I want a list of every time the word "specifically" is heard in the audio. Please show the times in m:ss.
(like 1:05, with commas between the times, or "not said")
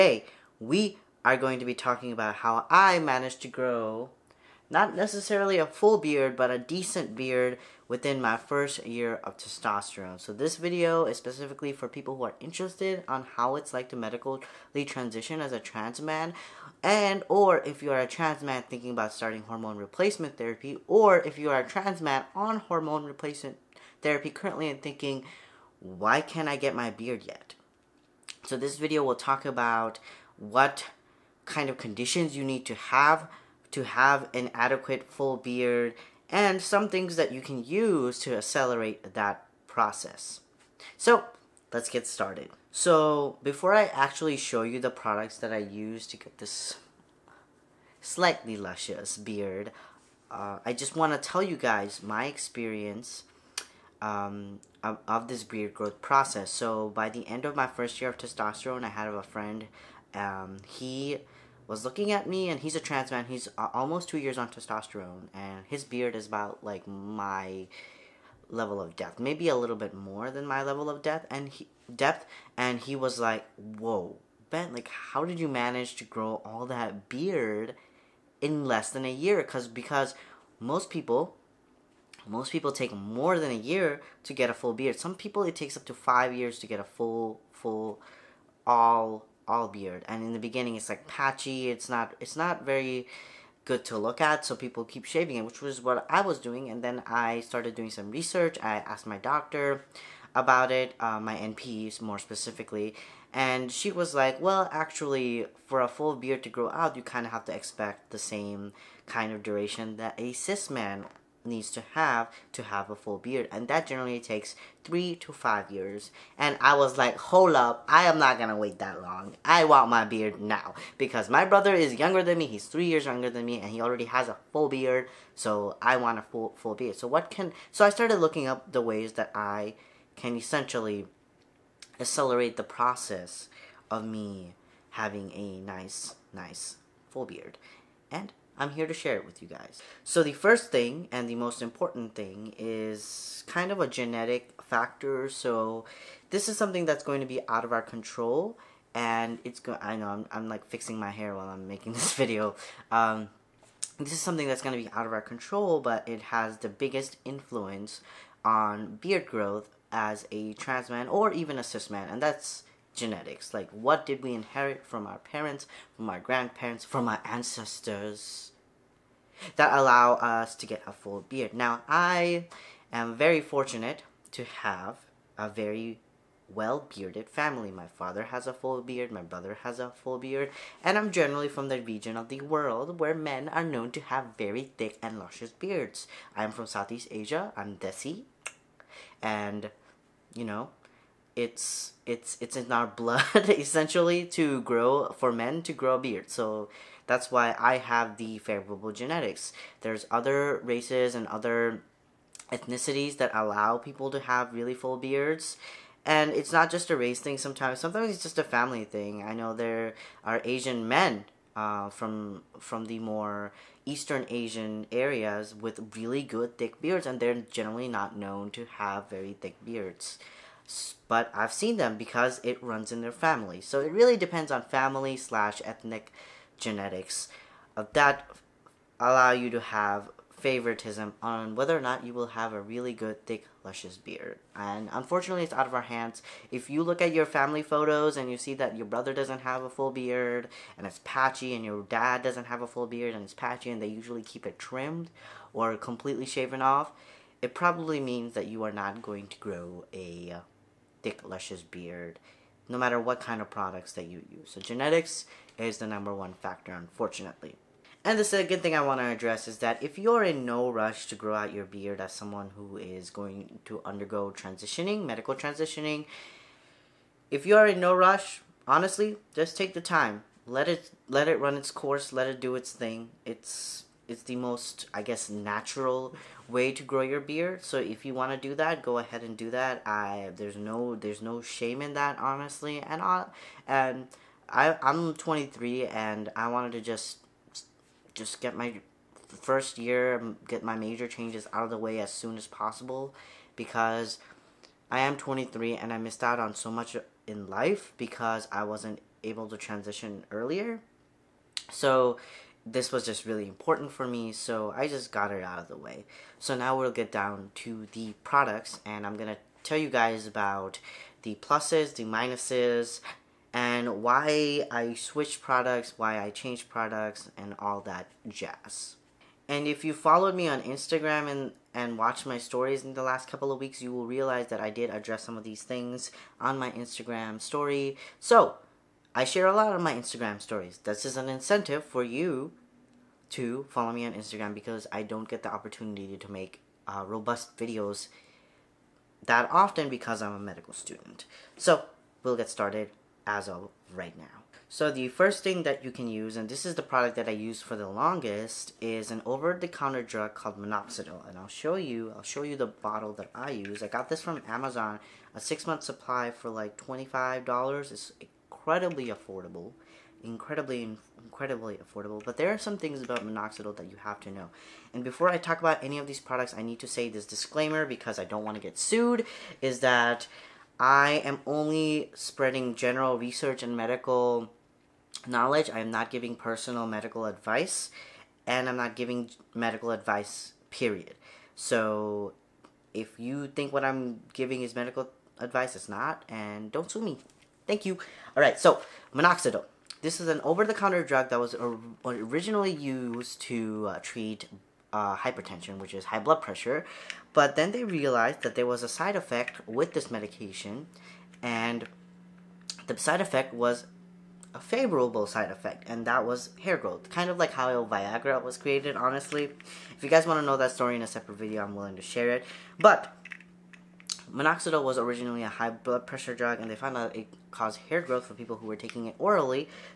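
0:11, 1:42.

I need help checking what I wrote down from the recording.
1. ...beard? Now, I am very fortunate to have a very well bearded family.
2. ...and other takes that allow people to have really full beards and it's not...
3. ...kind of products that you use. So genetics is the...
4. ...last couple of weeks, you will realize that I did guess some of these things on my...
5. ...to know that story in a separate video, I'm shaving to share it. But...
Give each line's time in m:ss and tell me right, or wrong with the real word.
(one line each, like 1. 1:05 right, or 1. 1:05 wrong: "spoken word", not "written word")
1. 2:51 right
2. 3:21 wrong: "ethnicities", not "takes"
3. 4:13 right
4. 5:23 wrong: "address", not "guess"
5. 6:50 wrong: "willing", not "shaving".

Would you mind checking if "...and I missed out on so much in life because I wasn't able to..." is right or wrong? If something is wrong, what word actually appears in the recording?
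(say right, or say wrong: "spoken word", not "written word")
right.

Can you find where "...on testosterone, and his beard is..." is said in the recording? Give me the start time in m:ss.
1:04.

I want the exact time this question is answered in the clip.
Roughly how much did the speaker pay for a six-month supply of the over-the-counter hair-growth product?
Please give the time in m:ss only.
5:56.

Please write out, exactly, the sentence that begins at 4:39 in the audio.
I there's no there's no shame in that honestly.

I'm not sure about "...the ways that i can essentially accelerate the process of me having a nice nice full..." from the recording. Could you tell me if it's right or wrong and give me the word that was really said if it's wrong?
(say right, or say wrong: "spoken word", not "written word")
right.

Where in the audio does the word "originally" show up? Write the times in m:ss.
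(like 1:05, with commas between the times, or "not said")
6:32, 6:54.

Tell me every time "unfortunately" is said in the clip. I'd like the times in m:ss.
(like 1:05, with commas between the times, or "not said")
3:54, 4:16.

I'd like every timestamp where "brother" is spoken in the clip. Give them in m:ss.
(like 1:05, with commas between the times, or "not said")
2:01, 2:59, 3:58.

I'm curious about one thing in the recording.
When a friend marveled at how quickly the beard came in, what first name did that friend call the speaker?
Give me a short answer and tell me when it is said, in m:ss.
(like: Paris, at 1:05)
Ben, at 1:14.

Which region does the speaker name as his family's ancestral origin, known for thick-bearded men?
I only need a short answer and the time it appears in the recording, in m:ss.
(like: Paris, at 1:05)
Southeast Asia, at 3:06.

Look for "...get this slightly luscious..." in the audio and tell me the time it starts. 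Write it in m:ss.
0:46.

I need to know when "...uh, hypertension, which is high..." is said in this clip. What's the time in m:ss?
6:34.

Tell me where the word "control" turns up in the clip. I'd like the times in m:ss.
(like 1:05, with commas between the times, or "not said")
2:27, 2:35.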